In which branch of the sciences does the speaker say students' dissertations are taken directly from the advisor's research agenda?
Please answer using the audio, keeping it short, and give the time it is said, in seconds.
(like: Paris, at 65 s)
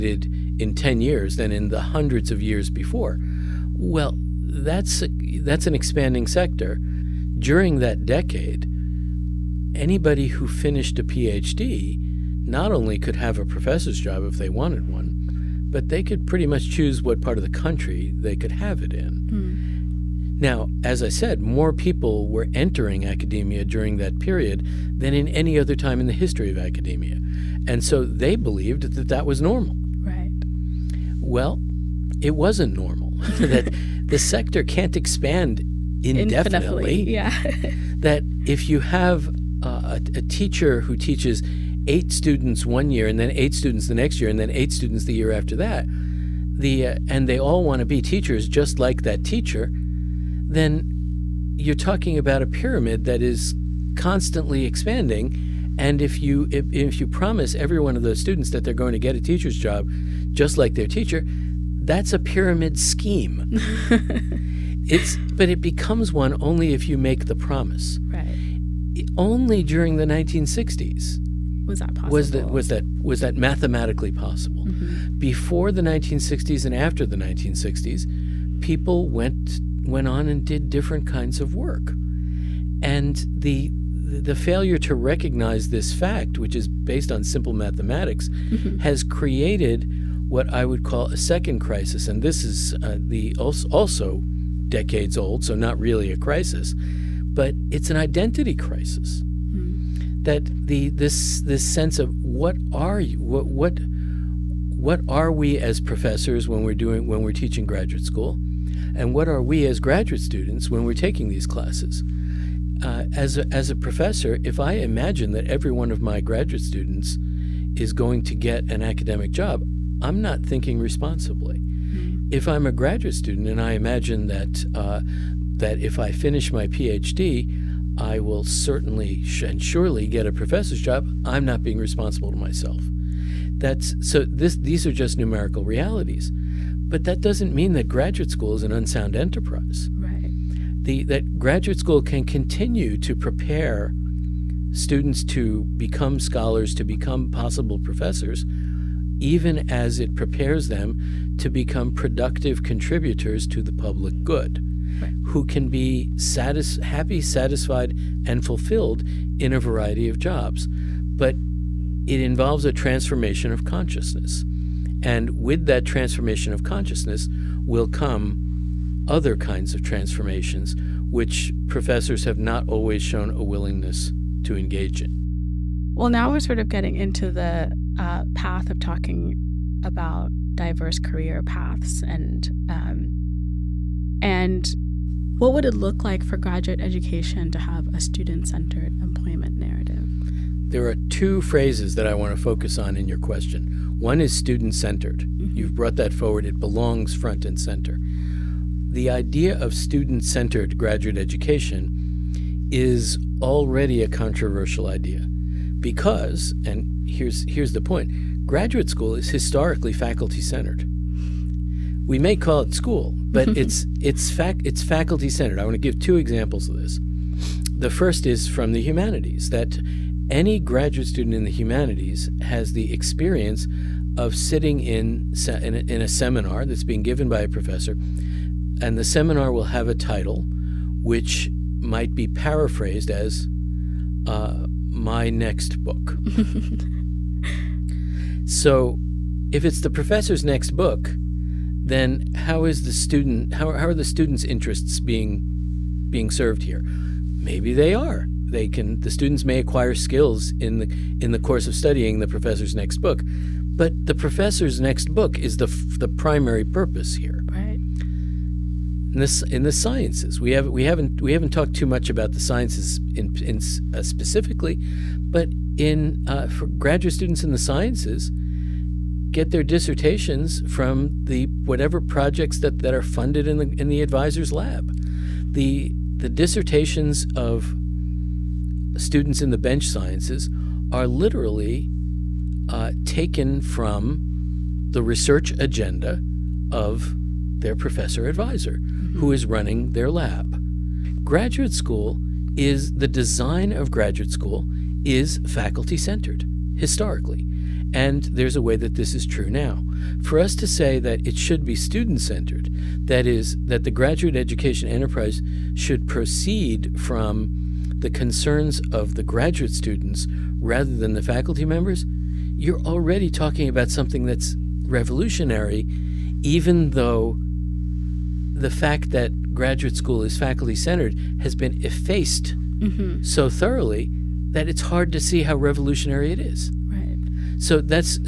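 Bench sciences, at 279 s.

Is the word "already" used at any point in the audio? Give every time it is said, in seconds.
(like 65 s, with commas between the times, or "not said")
203 s, 312 s.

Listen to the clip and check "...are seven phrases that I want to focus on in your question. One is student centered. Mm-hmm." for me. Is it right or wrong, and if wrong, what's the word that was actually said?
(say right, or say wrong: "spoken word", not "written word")
wrong: "two", not "seven".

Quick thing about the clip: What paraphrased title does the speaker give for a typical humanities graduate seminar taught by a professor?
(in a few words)
My Next Book.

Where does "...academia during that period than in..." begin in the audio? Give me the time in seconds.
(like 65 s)
23 s.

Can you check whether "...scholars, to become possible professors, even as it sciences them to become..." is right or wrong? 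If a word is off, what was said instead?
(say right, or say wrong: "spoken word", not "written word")
wrong: "prepares", not "sciences".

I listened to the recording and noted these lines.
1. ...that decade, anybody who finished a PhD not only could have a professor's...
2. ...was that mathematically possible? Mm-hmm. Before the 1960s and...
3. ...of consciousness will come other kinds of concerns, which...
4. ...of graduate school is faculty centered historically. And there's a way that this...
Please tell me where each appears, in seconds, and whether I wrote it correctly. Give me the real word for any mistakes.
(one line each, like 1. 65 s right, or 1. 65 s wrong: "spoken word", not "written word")
1. 7 s right
2. 72 s right
3. 166 s wrong: "transformations", not "concerns"
4. 293 s right.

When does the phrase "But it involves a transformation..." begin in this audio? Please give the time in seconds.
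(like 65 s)
161 s.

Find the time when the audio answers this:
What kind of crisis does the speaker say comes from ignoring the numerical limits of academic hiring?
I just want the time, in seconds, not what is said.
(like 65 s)
97 s.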